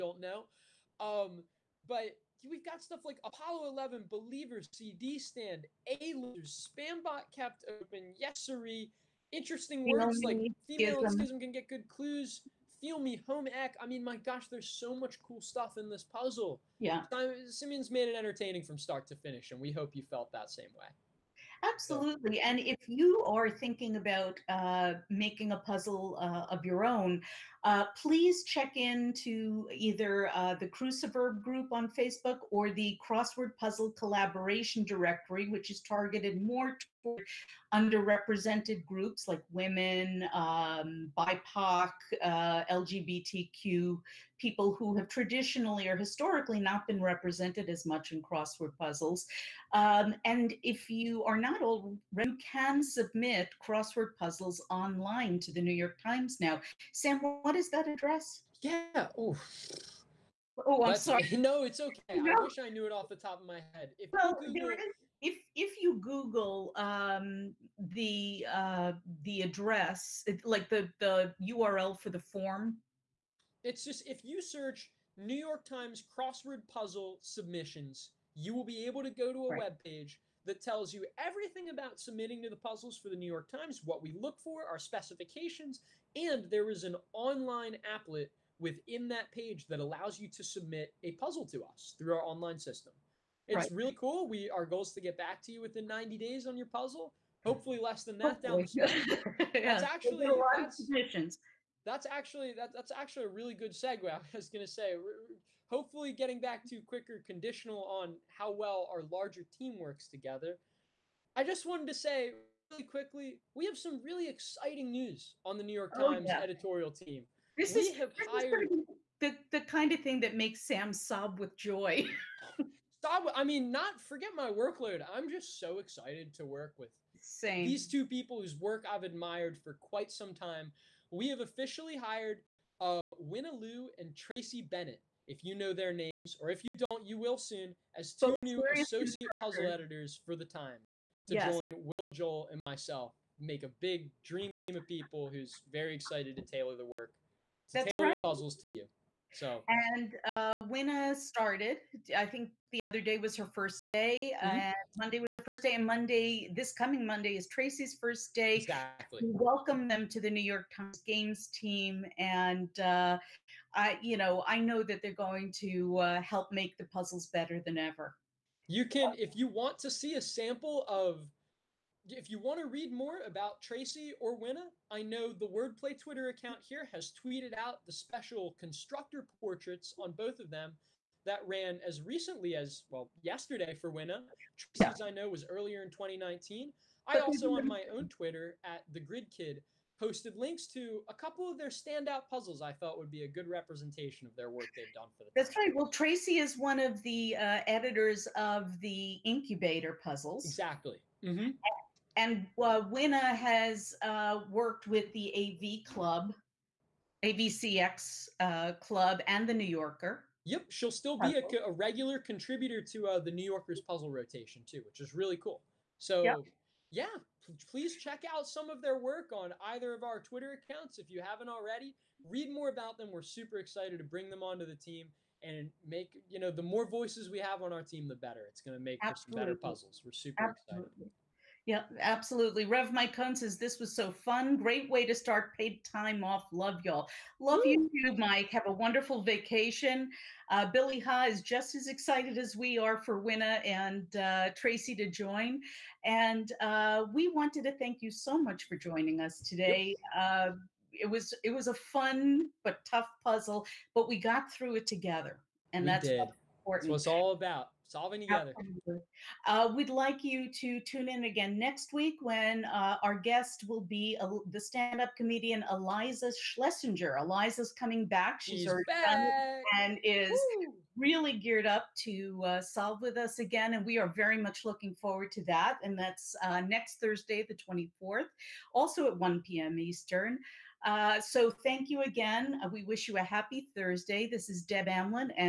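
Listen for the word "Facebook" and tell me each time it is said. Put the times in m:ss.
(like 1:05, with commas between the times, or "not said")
0:31.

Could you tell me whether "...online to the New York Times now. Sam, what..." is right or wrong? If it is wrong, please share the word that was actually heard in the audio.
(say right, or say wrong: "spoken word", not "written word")
right.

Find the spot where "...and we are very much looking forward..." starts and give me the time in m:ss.
4:33.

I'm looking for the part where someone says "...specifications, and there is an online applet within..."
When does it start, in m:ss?
1:24.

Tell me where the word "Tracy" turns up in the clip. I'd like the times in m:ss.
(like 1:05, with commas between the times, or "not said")
2:14, 2:37, 2:53, 3:04, 3:15, 4:04.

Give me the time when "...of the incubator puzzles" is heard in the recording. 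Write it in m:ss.
3:18.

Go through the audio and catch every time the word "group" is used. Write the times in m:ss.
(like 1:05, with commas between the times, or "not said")
0:31, 0:38.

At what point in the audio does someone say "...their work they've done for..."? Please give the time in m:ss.
3:14.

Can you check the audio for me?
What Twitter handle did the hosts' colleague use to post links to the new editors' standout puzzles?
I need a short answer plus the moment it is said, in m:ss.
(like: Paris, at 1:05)
The Grid Kid, at 3:08.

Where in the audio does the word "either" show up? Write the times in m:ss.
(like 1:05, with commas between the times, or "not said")
0:29, 3:39.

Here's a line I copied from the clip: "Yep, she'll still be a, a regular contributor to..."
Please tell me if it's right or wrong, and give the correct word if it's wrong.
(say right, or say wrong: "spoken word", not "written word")
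right.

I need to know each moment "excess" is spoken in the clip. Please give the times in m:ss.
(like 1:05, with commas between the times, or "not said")
not said.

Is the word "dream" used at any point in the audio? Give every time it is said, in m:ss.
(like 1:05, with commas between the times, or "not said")
2:24.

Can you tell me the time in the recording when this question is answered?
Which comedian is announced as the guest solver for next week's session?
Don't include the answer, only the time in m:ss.
4:25.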